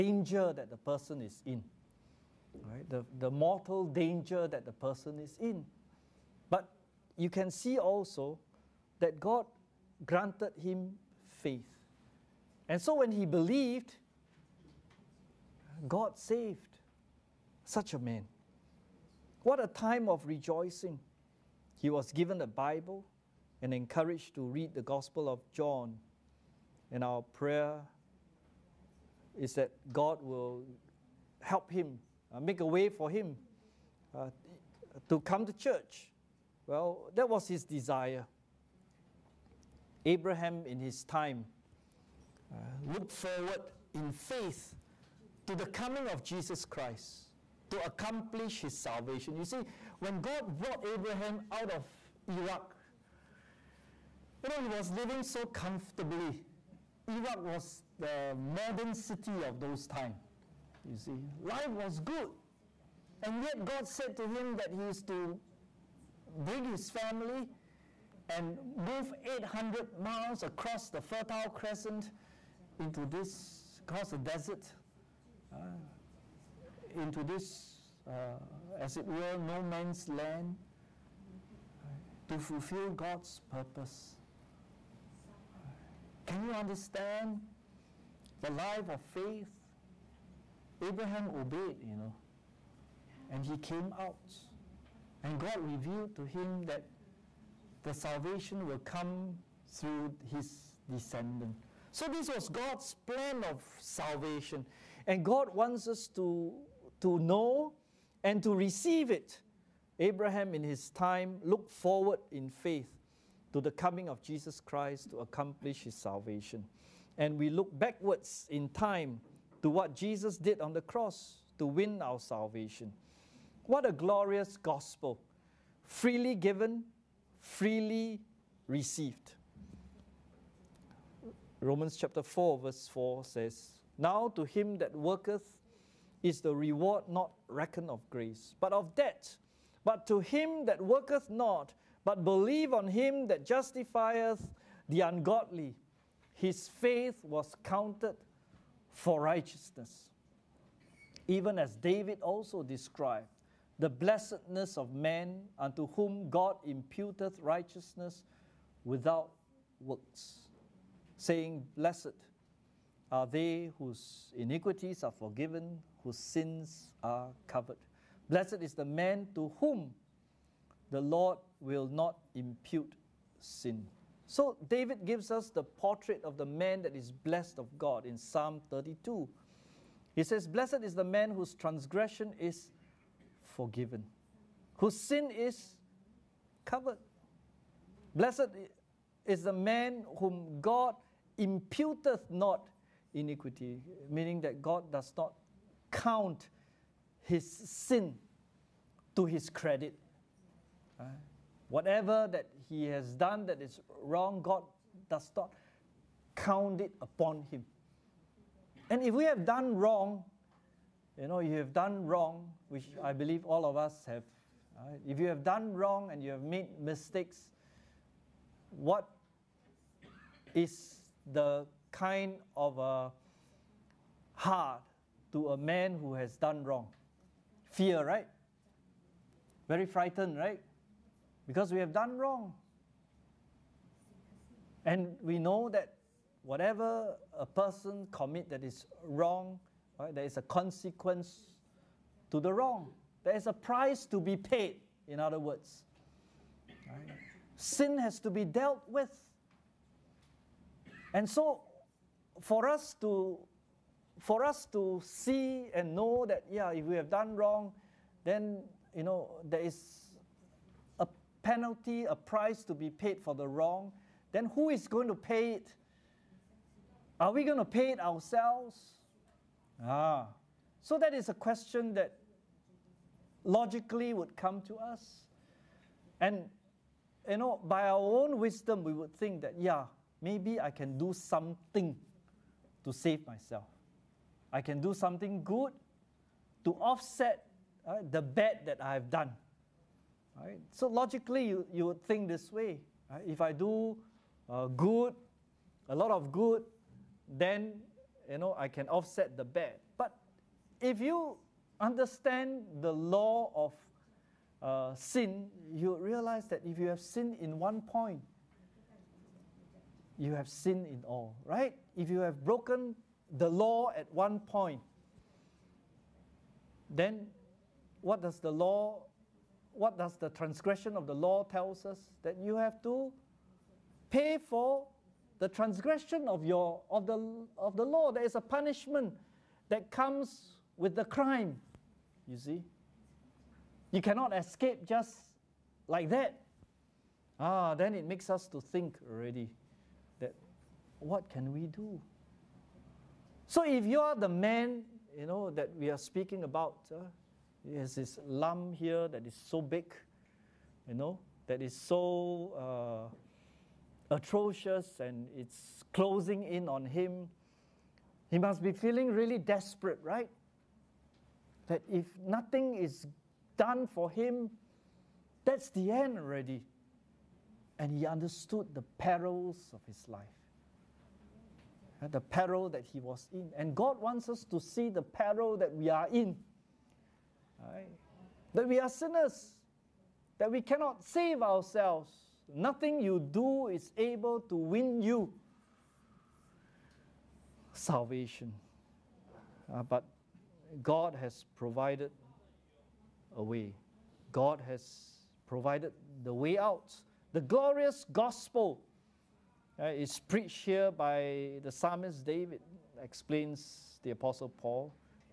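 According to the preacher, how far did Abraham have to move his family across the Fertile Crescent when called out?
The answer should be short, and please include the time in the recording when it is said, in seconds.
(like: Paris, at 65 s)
800 miles, at 69 s.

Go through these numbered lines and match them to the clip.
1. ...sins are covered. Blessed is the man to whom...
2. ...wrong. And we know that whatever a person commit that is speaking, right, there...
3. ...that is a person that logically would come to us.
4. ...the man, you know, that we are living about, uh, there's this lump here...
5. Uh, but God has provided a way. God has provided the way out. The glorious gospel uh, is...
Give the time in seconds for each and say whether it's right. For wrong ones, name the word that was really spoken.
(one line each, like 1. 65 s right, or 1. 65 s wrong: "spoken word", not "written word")
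1. 166 s right
2. 232 s wrong: "wrong", not "speaking"
3. 270 s wrong: "question", not "person"
4. 344 s wrong: "speaking", not "living"
5. 389 s right.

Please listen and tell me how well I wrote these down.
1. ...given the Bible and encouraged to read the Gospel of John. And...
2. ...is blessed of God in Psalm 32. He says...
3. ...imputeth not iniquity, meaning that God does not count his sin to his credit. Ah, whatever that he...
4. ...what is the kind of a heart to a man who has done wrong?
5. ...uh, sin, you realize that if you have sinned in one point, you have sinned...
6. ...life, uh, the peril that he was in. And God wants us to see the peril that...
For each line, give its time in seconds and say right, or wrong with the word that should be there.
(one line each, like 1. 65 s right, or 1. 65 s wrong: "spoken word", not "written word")
1. 22 s right
2. 176 s right
3. 191 s right
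4. 218 s right
5. 304 s right
6. 370 s right.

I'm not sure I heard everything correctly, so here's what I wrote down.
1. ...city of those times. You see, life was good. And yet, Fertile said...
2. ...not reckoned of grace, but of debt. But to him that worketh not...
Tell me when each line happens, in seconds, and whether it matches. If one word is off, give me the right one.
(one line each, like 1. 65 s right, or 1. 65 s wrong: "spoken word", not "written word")
1. 58 s wrong: "God", not "Fertile"
2. 137 s right.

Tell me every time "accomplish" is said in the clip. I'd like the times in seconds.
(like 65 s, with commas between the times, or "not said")
47 s, 115 s.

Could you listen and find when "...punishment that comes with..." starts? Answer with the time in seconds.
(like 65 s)
328 s.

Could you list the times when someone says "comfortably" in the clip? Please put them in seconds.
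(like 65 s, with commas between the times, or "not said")
55 s.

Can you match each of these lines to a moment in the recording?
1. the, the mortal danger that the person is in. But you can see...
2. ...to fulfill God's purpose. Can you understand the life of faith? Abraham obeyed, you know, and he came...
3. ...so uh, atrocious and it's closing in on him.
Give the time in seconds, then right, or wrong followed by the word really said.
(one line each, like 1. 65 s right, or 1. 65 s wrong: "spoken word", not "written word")
1. 2 s right
2. 82 s right
3. 351 s right.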